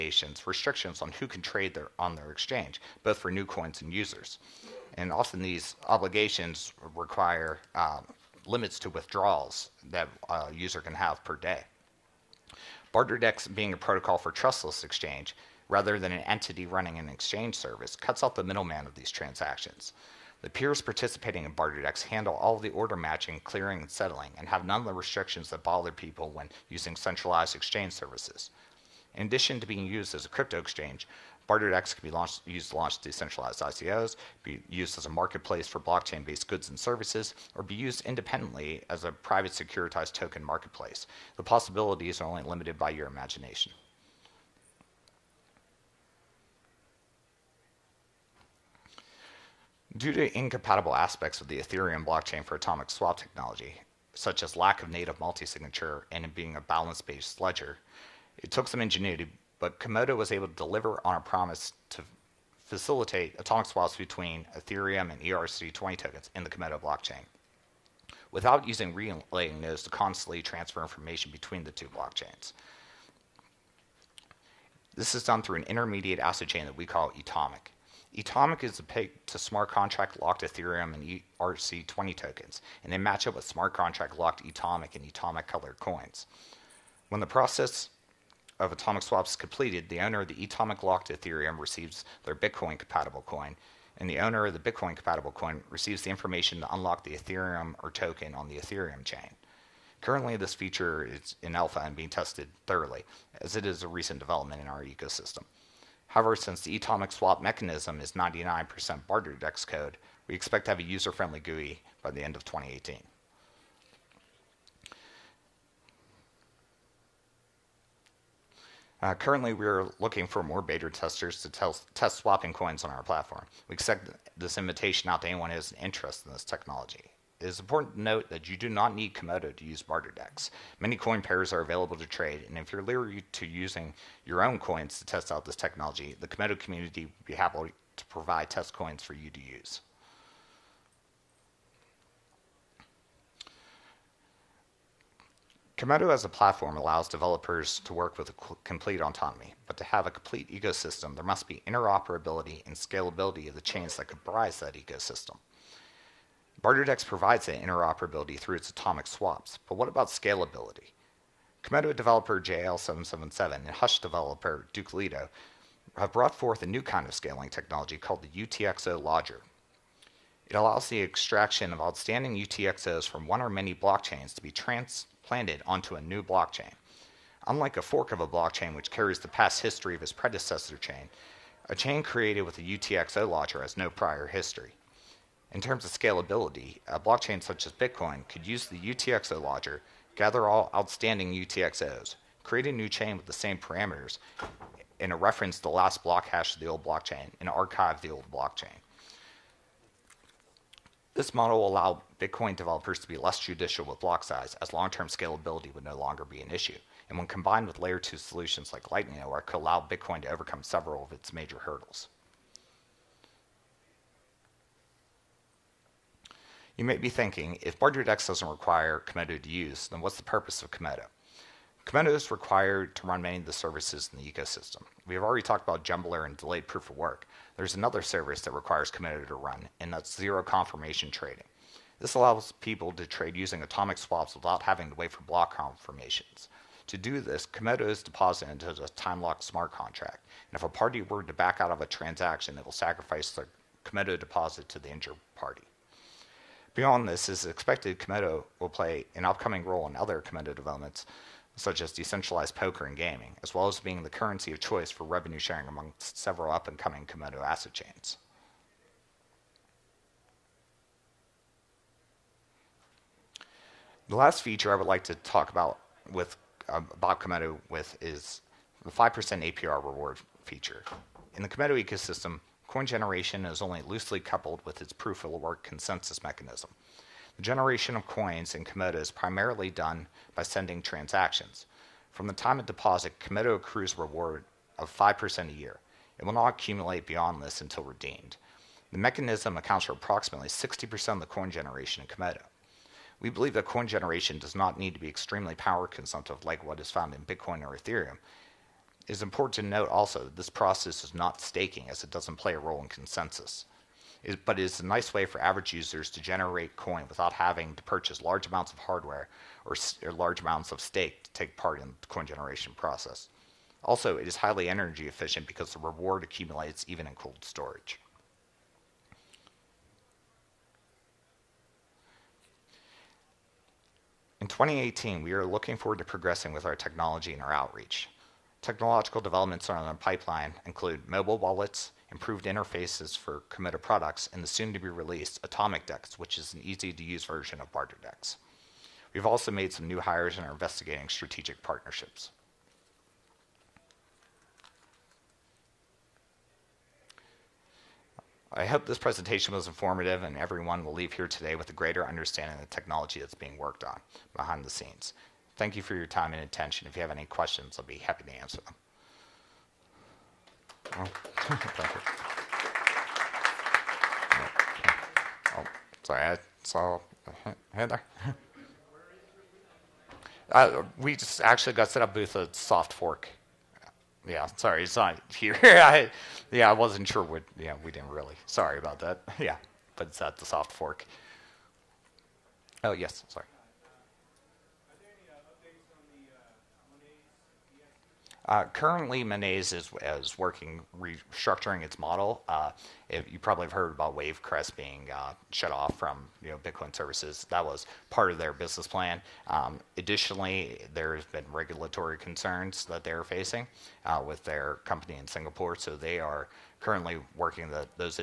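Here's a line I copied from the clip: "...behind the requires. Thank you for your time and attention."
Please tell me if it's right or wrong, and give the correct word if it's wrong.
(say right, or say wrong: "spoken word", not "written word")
wrong: "scenes", not "requires".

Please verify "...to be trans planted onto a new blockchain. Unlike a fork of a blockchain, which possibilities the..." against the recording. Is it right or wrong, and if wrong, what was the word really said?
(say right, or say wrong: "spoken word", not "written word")
wrong: "carries", not "possibilities".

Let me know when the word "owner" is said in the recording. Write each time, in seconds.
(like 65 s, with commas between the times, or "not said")
89 s, 94 s.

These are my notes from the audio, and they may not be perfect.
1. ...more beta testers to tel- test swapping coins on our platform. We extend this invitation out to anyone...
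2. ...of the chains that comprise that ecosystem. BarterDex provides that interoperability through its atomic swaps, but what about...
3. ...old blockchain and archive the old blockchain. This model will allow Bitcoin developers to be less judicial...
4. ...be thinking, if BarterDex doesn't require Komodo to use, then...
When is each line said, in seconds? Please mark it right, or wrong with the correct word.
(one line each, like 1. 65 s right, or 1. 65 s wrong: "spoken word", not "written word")
1. 120 s right
2. 153 s right
3. 196 s right
4. 216 s right.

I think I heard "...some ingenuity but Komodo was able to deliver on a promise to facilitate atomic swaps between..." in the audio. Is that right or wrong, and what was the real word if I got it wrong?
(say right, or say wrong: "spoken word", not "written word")
right.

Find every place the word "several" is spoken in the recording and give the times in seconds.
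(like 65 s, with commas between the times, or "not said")
210 s, 256 s.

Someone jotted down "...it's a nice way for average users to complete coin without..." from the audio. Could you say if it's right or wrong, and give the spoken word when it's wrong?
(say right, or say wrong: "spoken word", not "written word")
wrong: "generate", not "complete".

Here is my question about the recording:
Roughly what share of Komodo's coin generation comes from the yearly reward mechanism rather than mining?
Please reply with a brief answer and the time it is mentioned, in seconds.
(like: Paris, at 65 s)
60%, at 290 s.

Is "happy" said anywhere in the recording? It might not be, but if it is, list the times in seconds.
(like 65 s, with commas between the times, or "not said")
137 s, 357 s.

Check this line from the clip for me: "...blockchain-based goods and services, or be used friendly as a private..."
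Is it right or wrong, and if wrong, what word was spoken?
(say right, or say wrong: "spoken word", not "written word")
wrong: "independently", not "friendly".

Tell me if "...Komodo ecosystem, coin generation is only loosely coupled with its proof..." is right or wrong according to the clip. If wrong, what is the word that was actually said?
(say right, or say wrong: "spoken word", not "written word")
right.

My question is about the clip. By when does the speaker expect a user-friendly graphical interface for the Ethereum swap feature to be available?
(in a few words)
end of 2018.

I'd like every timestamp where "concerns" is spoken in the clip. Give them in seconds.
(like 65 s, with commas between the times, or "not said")
402 s.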